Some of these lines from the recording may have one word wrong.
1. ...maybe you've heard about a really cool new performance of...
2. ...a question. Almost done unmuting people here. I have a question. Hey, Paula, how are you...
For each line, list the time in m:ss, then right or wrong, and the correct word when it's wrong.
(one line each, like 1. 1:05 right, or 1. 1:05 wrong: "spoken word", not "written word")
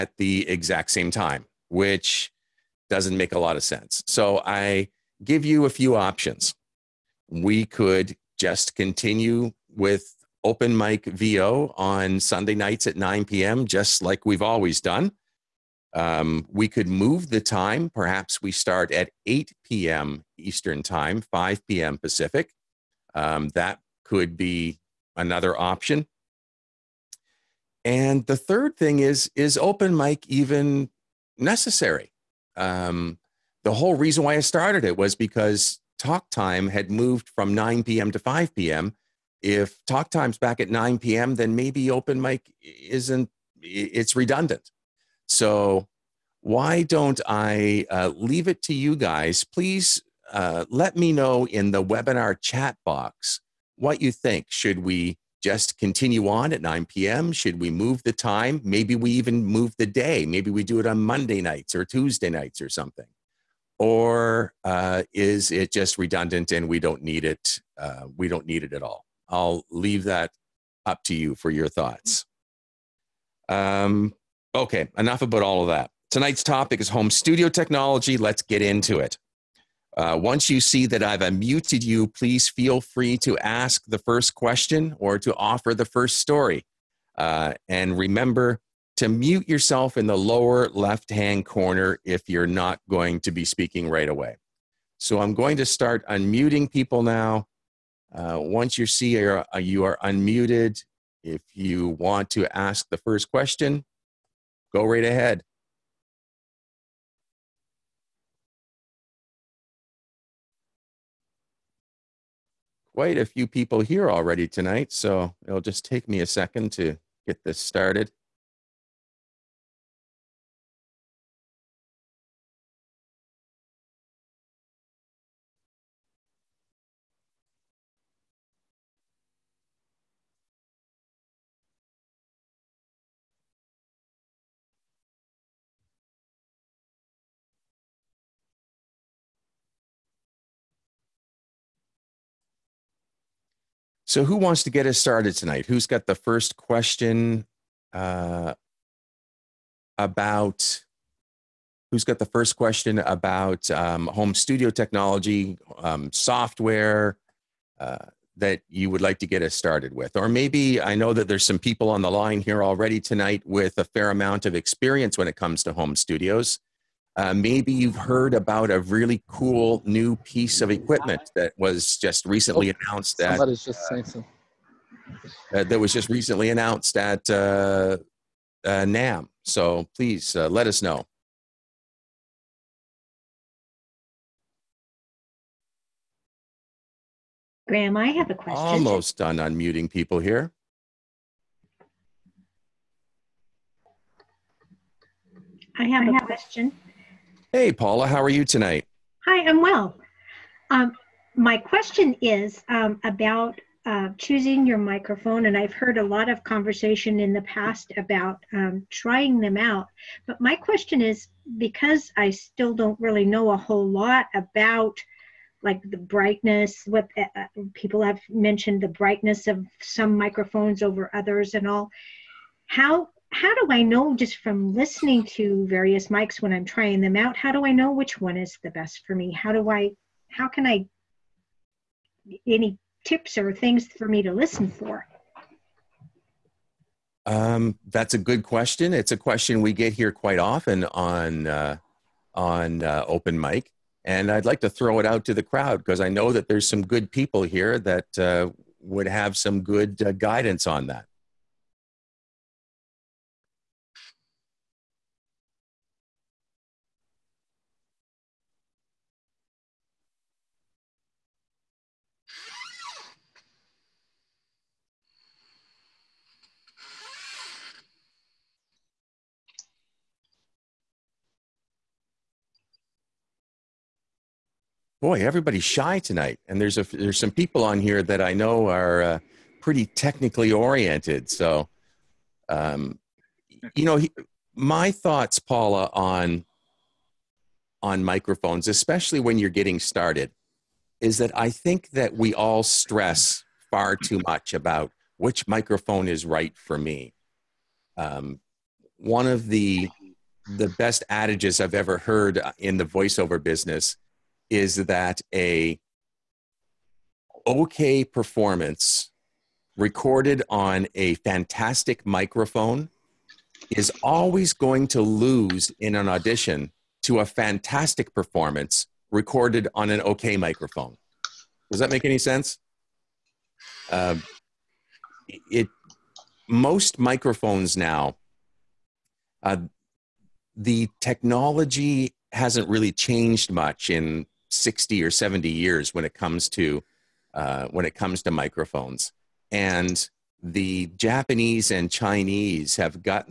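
1. 2:47 wrong: "piece", not "performance"
2. 3:08 right.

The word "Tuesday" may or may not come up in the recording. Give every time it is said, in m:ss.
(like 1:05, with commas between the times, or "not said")
1:01.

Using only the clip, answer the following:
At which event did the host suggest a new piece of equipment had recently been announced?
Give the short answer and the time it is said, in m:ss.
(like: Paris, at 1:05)
NAMM, at 2:58.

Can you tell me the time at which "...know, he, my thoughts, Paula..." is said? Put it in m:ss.
4:43.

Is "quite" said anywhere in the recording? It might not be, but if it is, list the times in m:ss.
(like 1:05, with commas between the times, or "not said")
1:52, 4:00.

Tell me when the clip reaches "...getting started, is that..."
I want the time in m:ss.
4:49.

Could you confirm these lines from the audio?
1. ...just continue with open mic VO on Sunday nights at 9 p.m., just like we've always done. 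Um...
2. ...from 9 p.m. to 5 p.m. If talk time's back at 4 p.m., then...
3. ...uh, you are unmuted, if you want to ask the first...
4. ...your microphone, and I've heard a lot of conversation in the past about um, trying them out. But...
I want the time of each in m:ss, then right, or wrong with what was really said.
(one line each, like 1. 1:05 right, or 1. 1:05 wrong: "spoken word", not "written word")
1. 0:08 right
2. 0:37 wrong: "9", not "4"
3. 1:39 right
4. 3:24 right.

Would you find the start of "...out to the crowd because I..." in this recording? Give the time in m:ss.
4:05.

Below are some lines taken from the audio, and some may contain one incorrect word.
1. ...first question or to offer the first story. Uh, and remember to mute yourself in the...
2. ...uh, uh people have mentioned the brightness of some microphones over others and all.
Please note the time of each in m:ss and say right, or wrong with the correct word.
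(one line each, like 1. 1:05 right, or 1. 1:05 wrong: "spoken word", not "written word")
1. 1:23 right
2. 3:37 right.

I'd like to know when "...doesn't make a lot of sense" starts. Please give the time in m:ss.
0:02.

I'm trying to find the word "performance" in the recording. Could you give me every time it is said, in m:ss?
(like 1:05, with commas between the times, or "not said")
5:08, 5:18.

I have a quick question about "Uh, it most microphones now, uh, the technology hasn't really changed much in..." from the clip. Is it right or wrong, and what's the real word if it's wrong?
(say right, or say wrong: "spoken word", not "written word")
right.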